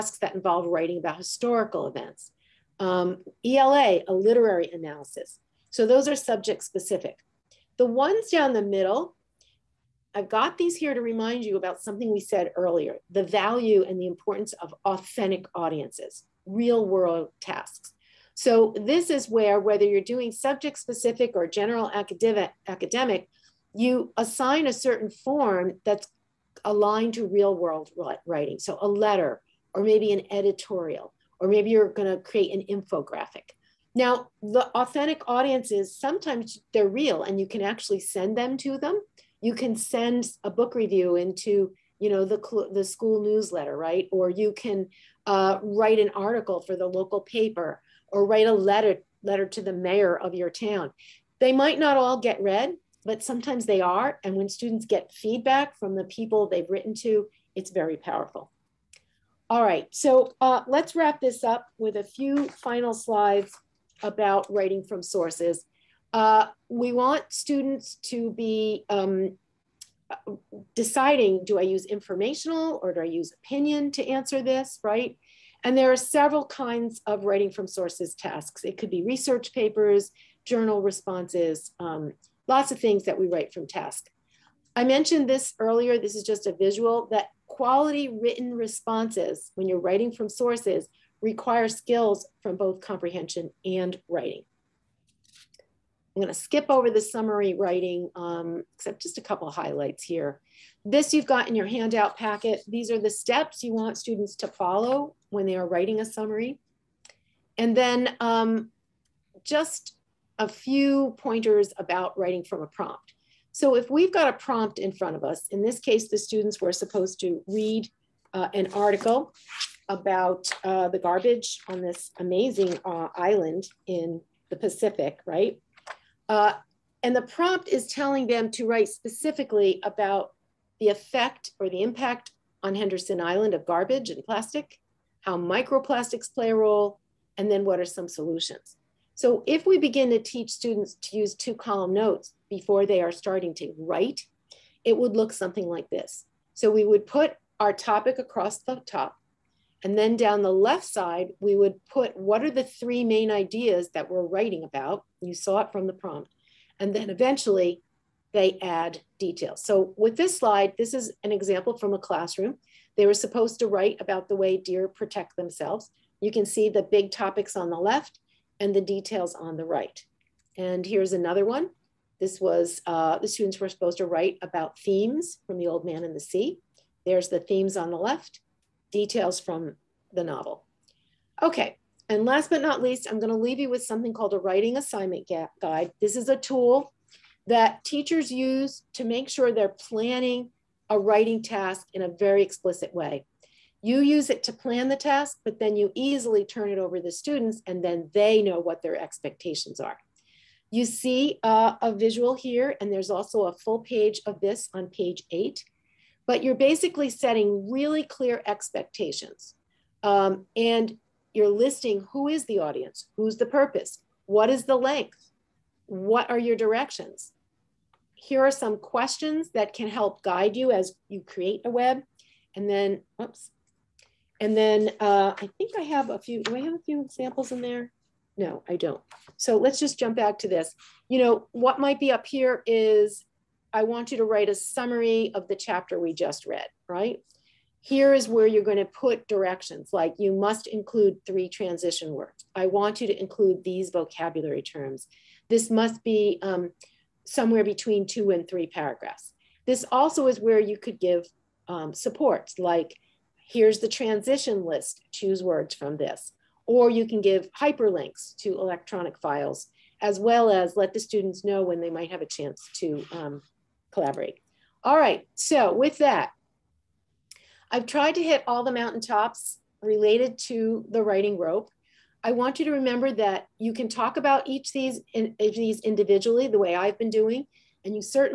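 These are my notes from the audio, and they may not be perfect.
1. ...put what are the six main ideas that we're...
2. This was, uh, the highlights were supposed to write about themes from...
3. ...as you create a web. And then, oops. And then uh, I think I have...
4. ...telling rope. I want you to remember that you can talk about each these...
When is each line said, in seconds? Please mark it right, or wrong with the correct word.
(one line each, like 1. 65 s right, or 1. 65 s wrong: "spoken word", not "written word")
1. 151 s wrong: "three", not "six"
2. 172 s wrong: "students", not "highlights"
3. 220 s right
4. 271 s wrong: "writing", not "telling".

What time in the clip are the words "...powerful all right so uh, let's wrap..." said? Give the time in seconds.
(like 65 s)
57 s.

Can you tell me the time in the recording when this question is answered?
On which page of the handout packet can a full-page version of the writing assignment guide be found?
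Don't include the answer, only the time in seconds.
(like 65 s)
204 s.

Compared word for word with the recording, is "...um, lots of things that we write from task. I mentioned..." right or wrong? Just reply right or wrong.
right.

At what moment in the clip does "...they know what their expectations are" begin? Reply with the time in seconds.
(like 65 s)
198 s.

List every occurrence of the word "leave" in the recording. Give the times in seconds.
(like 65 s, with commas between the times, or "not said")
183 s.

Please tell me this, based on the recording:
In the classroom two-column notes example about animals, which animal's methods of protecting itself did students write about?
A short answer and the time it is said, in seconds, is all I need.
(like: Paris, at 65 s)
Deer, at 164 s.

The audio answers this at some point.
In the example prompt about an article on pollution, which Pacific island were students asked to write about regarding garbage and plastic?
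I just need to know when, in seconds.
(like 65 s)
132 s.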